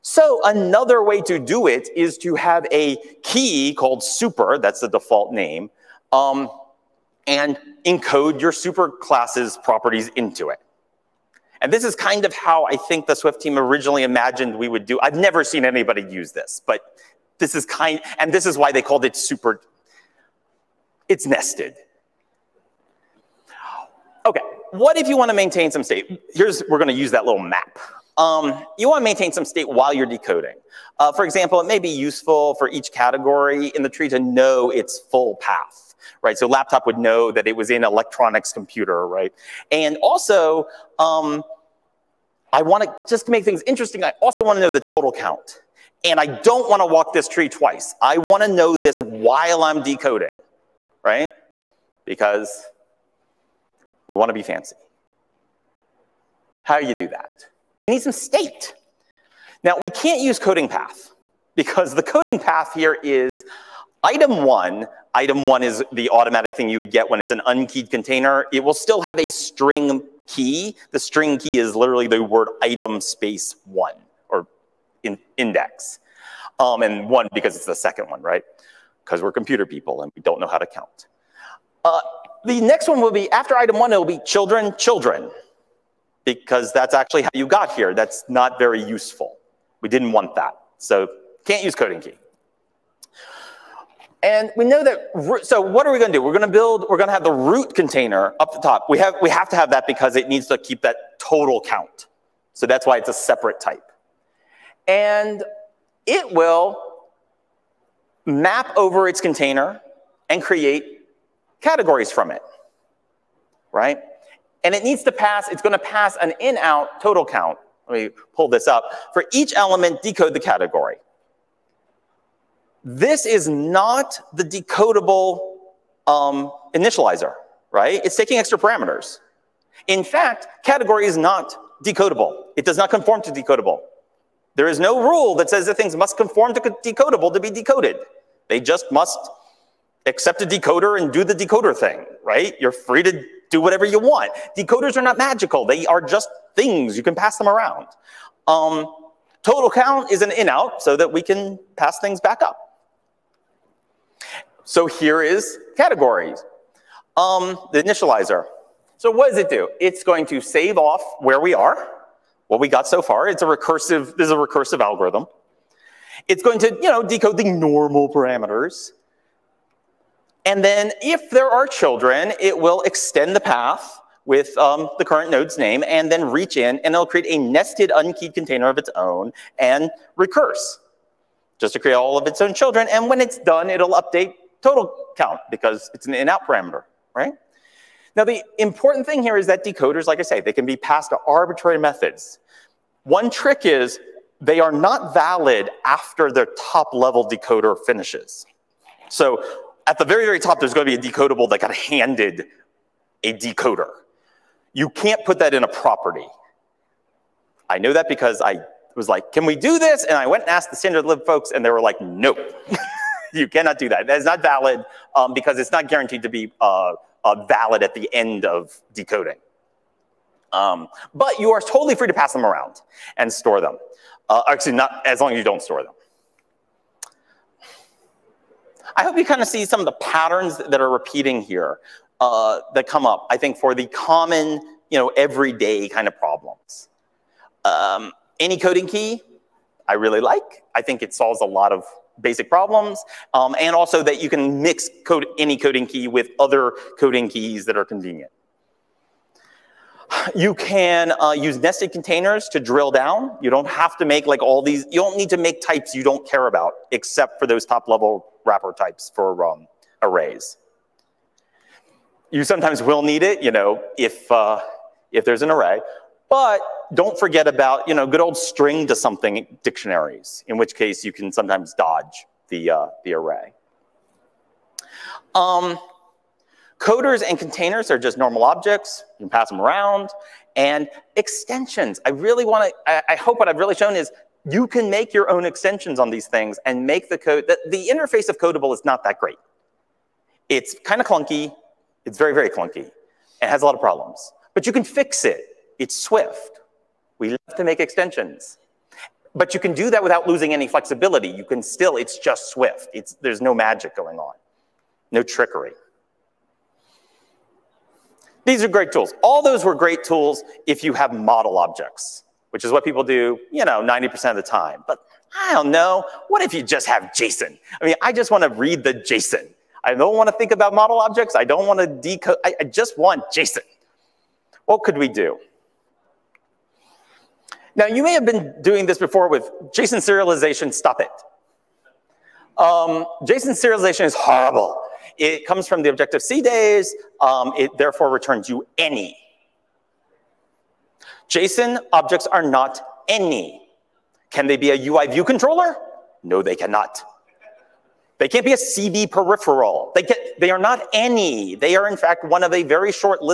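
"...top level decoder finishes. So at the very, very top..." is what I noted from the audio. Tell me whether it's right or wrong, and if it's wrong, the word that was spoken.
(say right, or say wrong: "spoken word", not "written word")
right.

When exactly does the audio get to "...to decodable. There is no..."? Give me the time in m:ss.
2:13.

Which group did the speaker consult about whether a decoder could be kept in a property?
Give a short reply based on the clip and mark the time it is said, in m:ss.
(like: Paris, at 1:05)
the standard lib folks, at 3:30.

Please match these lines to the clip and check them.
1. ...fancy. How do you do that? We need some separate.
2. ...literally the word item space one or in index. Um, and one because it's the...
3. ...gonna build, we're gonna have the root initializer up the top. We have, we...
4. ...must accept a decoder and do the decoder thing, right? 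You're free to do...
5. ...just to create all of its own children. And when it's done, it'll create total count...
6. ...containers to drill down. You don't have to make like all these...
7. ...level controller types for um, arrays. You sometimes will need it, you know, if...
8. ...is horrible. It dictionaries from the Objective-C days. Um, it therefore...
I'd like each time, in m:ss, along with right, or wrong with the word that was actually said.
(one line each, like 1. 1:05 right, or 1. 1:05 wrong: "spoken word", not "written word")
1. 0:54 wrong: "state", not "separate"
2. 1:11 right
3. 1:36 wrong: "container", not "initializer"
4. 2:18 right
5. 3:01 wrong: "update", not "create"
6. 4:11 right
7. 4:17 wrong: "wrapper", not "controller"
8. 5:34 wrong: "comes", not "dictionaries".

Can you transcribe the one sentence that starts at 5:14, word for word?
But I don't know, what if you just have JSON?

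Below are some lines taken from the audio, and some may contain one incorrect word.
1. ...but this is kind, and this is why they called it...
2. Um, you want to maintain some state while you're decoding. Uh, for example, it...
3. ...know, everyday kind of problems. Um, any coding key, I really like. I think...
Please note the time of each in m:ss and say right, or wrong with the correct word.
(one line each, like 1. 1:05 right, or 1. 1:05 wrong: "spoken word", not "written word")
1. 0:16 right
2. 0:28 right
3. 3:54 right.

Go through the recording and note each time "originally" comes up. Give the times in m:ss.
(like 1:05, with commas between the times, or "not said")
0:13.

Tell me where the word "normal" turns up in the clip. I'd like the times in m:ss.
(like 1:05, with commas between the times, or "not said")
2:47, 4:38.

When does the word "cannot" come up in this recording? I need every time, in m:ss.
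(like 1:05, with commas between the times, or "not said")
3:33, 5:46.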